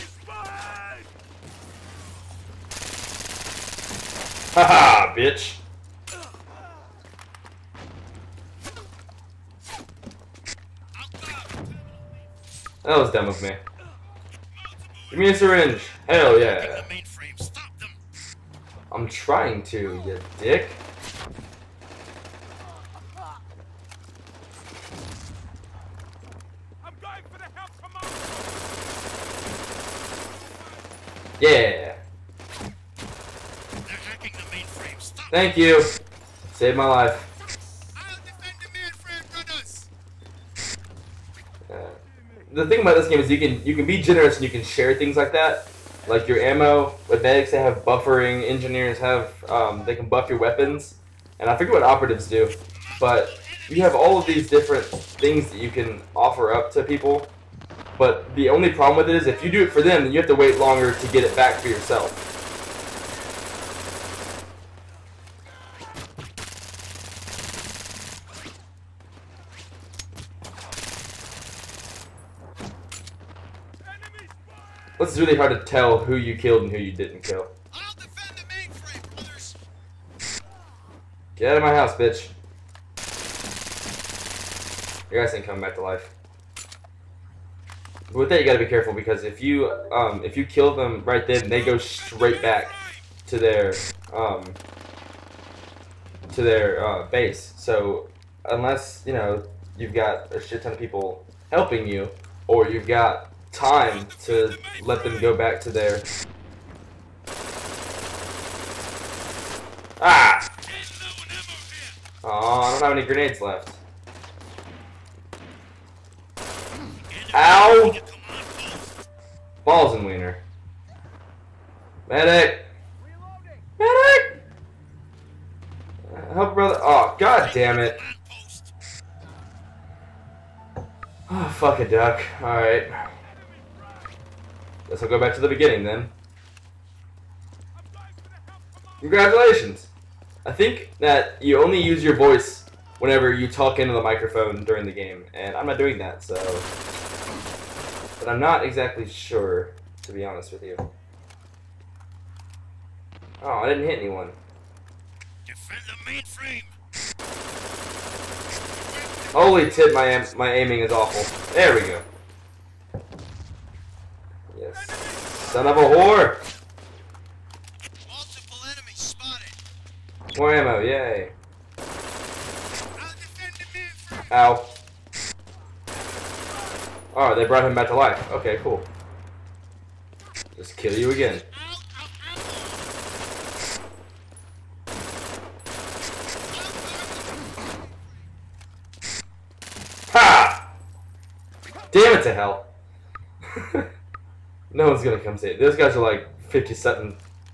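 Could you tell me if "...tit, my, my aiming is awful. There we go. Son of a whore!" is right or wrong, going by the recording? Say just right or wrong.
right.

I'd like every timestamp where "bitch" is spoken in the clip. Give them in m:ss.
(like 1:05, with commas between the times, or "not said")
0:05, 1:21.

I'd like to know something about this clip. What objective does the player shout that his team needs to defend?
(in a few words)
the mainframe.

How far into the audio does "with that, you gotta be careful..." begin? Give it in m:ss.
1:28.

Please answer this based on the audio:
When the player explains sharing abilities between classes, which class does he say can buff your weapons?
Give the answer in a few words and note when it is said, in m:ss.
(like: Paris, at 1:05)
Engineers, at 0:48.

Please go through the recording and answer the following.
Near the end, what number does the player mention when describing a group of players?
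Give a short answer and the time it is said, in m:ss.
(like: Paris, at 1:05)
57, at 3:16.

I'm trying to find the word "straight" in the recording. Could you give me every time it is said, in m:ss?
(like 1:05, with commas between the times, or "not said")
1:31.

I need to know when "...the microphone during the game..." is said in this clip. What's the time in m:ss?
2:23.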